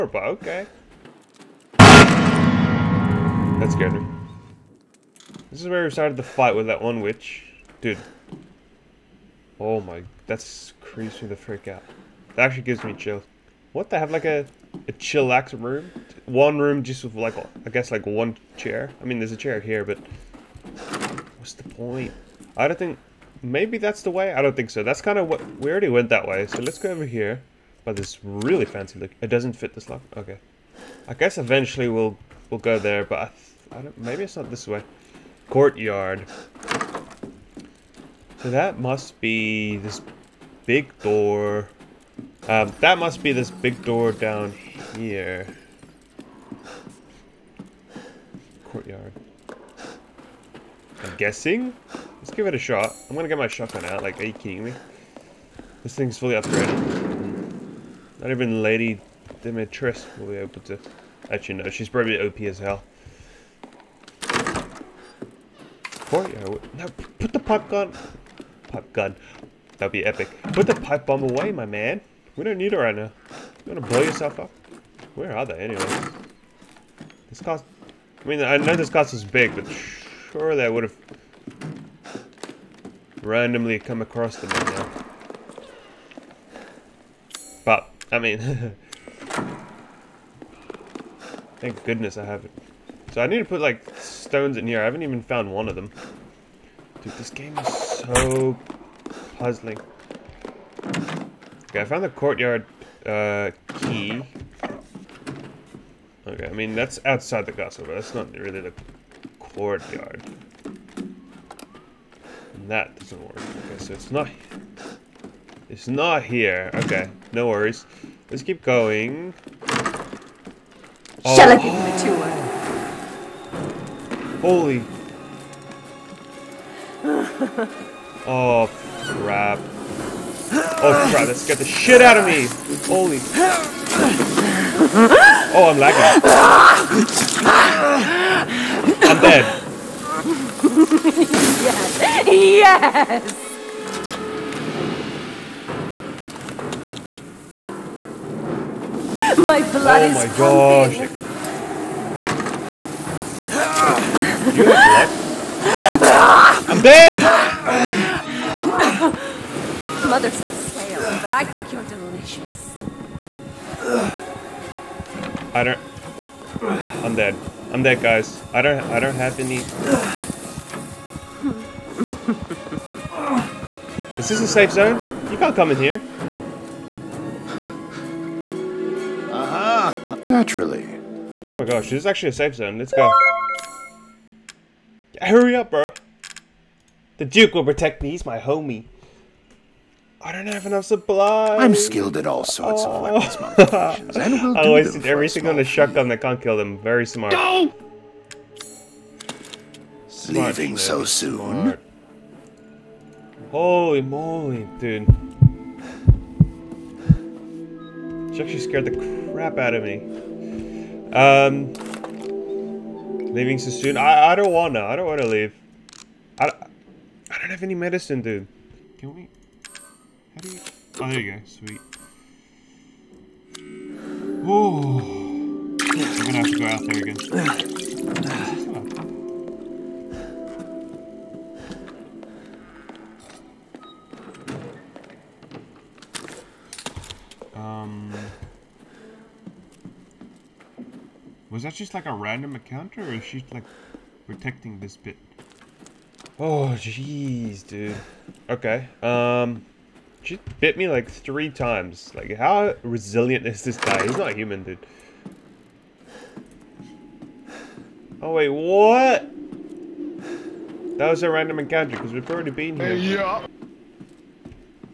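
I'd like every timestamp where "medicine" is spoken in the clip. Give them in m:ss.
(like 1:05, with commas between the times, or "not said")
3:37.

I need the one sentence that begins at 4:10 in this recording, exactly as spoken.
She bit me like three times.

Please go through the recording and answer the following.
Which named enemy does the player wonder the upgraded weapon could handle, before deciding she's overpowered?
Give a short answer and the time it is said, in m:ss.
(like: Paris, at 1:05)
Lady Dimitrescu, at 0:58.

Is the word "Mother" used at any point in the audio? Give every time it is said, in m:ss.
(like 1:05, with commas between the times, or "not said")
2:40.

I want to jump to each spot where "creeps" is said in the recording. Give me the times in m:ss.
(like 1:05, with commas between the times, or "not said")
0:10.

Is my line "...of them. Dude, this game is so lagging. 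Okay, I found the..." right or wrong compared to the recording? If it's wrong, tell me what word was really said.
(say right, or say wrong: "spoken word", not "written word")
wrong: "puzzling", not "lagging".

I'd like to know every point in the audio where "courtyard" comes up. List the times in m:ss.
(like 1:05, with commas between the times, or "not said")
0:35, 0:48, 1:06, 1:42, 1:49.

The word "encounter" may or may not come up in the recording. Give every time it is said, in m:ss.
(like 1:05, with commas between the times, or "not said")
4:02, 4:21.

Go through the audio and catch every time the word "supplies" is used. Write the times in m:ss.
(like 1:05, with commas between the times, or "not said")
3:10.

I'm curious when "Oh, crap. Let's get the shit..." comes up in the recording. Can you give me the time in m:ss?
2:10.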